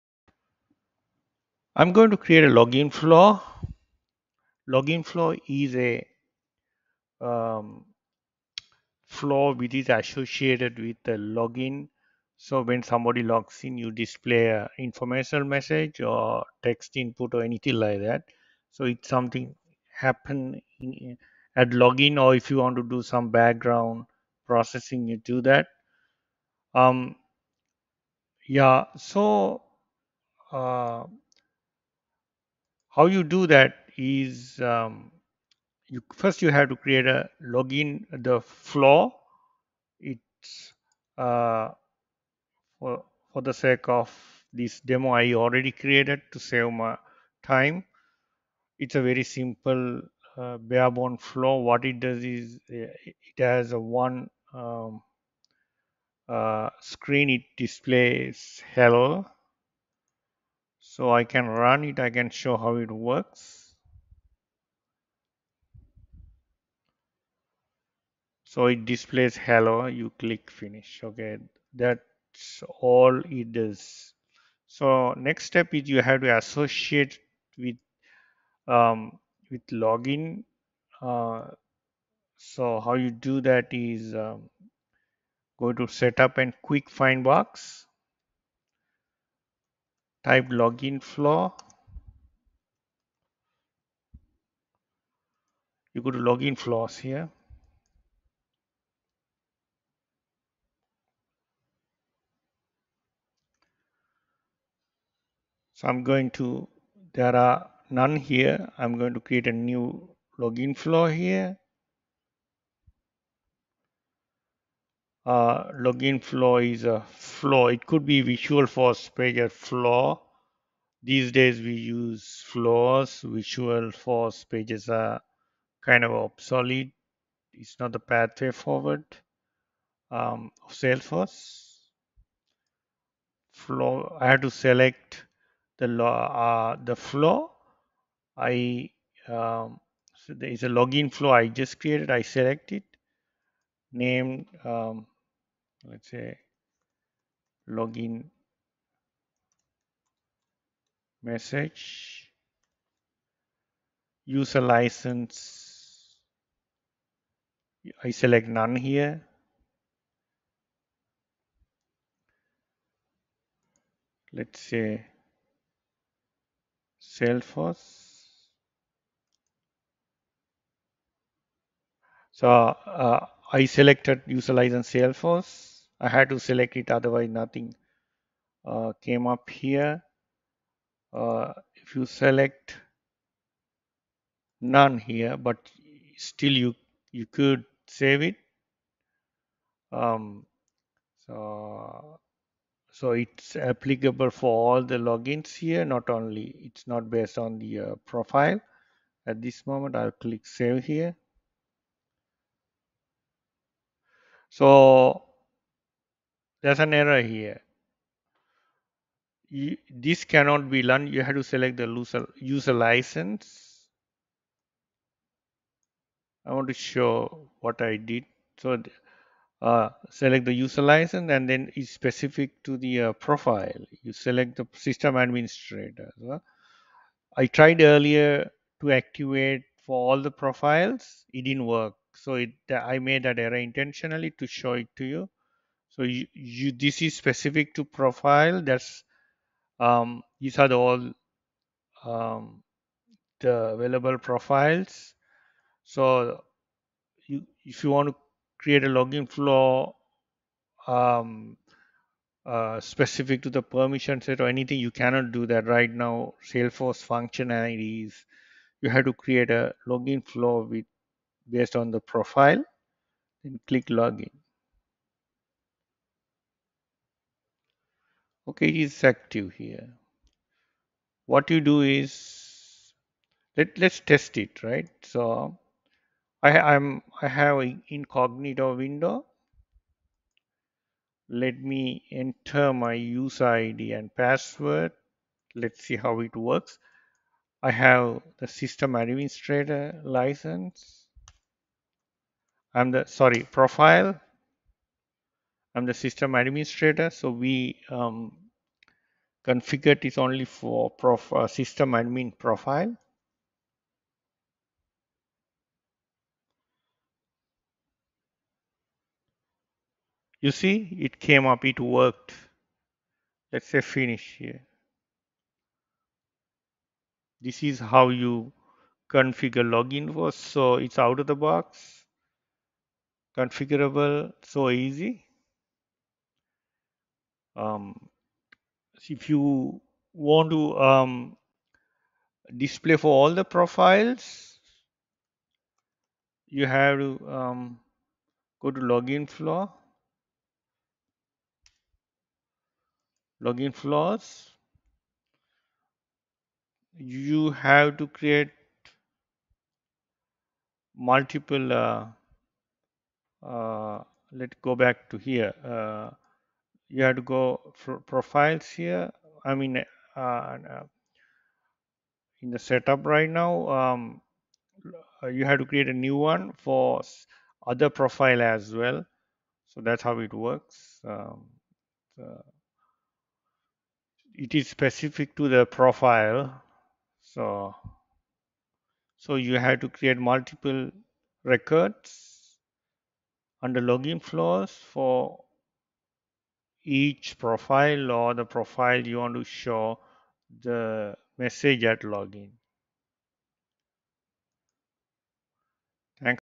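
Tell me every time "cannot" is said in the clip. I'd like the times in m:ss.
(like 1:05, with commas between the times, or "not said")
3:30, 4:14.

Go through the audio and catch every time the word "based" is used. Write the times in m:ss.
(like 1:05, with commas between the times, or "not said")
3:17, 4:21.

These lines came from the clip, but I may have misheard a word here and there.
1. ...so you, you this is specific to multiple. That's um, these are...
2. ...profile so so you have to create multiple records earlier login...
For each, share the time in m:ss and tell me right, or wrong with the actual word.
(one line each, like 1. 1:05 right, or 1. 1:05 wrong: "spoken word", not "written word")
1. 3:55 wrong: "profile", not "multiple"
2. 6:15 wrong: "under", not "earlier".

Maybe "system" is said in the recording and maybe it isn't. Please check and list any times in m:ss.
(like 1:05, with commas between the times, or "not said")
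3:44, 4:48, 4:55, 5:01.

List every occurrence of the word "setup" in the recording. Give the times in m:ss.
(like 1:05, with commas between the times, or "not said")
1:25, 6:02.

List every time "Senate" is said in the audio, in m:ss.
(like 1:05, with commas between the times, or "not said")
not said.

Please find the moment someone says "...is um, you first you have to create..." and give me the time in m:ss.
0:33.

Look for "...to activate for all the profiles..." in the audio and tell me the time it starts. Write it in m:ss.
3:48.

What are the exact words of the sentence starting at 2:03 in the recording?
Visualforce pages are kind of obsolete.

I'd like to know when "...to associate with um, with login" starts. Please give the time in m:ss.
1:16.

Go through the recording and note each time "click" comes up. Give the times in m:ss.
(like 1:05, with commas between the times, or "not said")
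1:10, 3:20, 4:23.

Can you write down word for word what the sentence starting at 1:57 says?
It could be Visualforce Pager flow.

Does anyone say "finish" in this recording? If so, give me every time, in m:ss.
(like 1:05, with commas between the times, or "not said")
1:10, 5:13.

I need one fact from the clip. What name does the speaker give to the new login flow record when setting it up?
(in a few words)
Login message.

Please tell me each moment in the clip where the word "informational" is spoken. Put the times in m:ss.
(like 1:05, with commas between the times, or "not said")
0:14.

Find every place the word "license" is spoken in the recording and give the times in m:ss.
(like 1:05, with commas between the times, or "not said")
2:34, 2:54, 3:32, 3:40, 4:50.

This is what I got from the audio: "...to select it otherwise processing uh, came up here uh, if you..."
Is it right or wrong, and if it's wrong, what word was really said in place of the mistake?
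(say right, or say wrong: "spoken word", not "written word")
wrong: "nothing", not "processing".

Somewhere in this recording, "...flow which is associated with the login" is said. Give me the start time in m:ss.
0:09.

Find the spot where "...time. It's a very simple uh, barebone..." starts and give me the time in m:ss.
0:47.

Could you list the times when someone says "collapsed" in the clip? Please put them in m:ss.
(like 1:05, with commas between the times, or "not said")
not said.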